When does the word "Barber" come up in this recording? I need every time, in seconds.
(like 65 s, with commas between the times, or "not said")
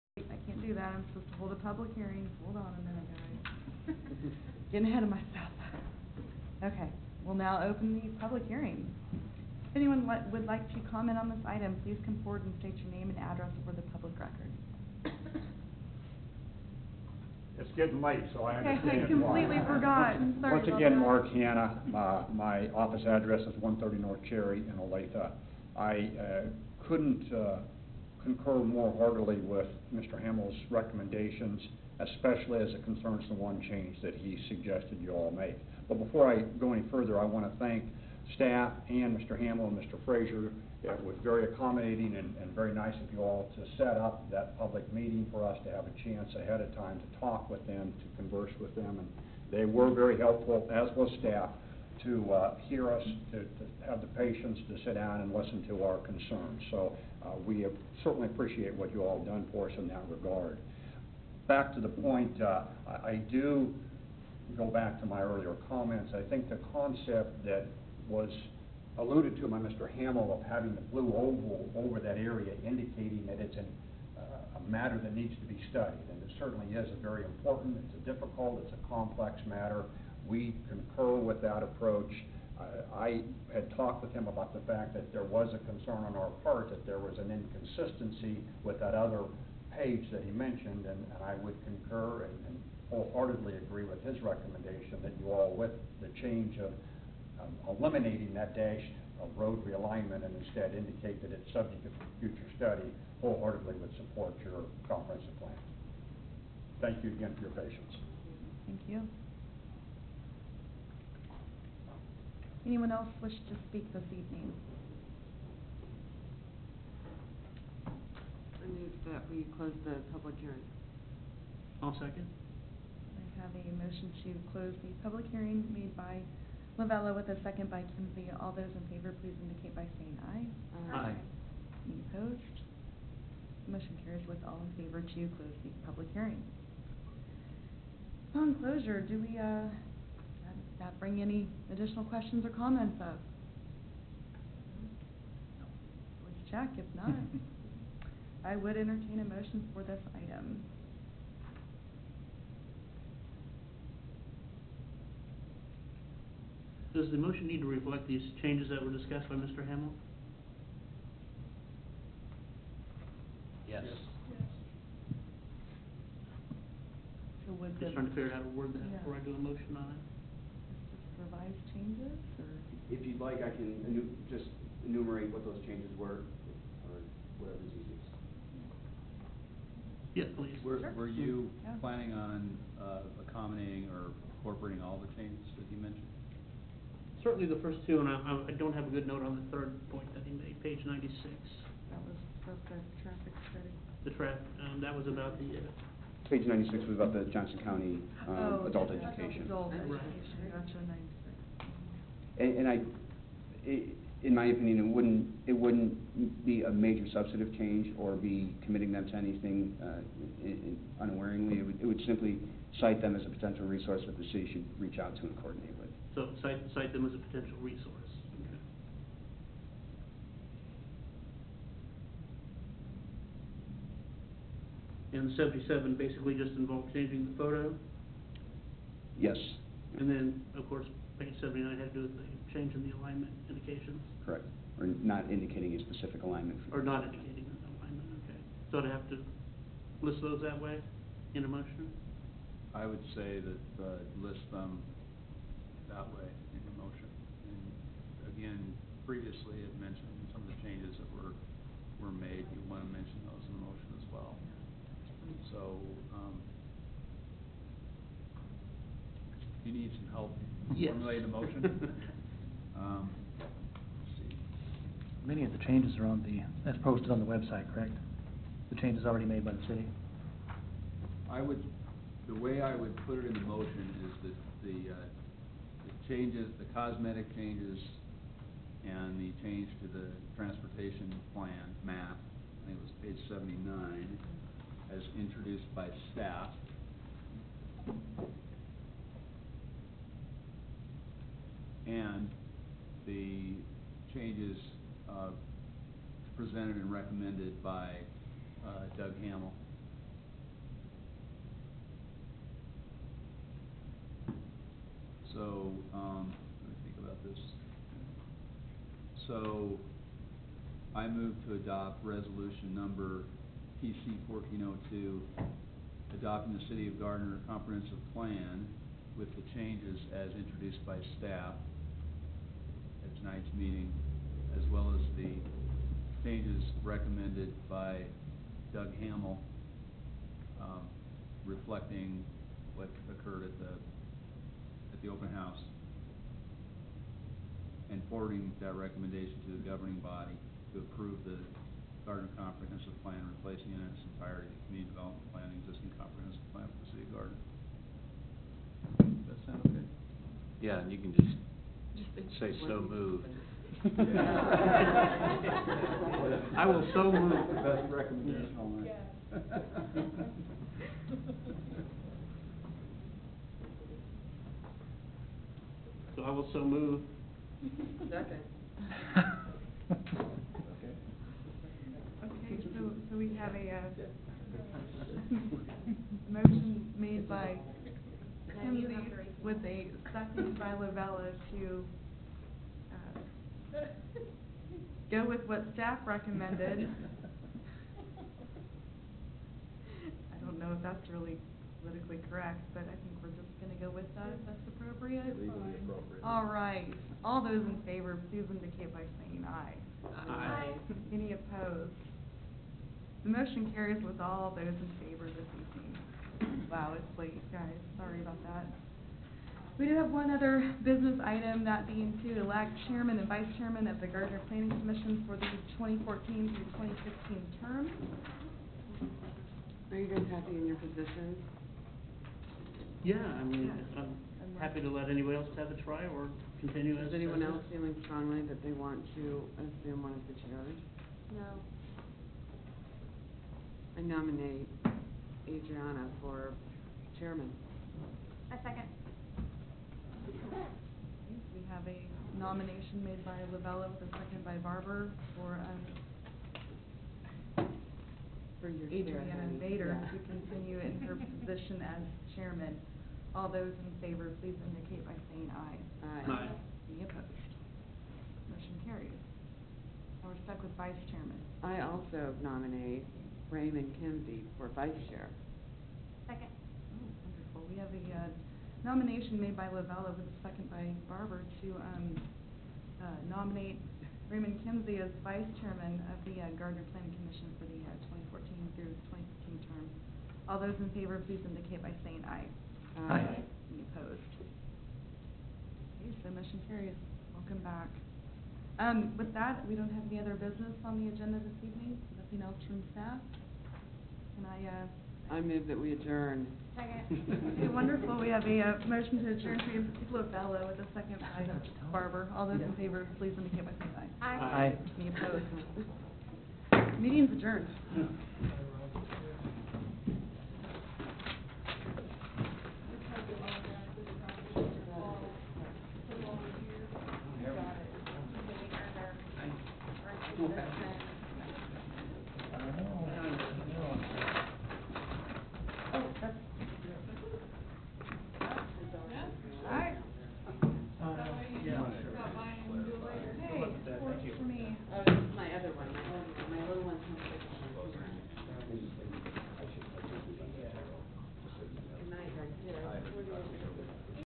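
444 s, 471 s, 501 s.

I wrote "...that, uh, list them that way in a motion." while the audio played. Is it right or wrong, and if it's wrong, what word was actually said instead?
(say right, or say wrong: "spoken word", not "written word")
right.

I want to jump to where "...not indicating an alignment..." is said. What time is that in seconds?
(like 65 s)
236 s.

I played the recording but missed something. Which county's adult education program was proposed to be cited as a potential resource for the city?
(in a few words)
Johnson County.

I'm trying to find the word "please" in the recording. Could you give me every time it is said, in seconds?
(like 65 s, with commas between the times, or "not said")
11 s, 129 s, 180 s, 398 s, 454 s, 481 s, 503 s.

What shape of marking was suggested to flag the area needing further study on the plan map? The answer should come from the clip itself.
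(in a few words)
blue oval.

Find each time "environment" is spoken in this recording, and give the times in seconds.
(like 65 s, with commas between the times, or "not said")
not said.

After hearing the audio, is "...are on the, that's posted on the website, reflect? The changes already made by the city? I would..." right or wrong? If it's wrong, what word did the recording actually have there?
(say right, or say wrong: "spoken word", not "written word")
wrong: "correct", not "reflect".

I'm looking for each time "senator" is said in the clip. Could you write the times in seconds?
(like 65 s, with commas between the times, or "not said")
not said.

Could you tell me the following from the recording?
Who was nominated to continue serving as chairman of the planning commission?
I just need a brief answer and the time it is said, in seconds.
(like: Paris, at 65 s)
Adriana Vader, at 448 s.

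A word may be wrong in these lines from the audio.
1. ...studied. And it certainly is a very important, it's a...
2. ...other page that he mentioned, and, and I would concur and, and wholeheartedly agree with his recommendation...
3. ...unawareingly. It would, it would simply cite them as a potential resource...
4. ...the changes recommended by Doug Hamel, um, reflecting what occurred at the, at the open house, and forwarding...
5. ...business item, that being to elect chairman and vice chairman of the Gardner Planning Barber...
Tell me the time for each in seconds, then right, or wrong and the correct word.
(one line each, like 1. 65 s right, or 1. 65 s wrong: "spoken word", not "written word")
1. 75 s right
2. 88 s right
3. 211 s right
4. 325 s right
5. 410 s wrong: "Commission", not "Barber".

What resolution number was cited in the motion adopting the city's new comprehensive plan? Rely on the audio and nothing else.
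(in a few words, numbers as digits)
PC 1402.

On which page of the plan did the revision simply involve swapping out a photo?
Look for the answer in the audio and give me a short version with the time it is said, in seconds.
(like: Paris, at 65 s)
77, at 225 s.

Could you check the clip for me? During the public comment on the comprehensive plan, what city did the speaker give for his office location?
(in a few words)
Olathe.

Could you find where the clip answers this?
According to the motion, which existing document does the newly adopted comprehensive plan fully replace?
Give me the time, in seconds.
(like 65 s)
344 s.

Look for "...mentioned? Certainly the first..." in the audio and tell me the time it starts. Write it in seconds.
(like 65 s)
185 s.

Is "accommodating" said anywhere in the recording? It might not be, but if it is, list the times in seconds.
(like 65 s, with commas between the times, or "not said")
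41 s, 183 s.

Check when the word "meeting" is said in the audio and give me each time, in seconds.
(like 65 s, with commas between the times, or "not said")
44 s, 323 s, 507 s.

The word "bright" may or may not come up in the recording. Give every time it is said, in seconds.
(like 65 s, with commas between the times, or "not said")
not said.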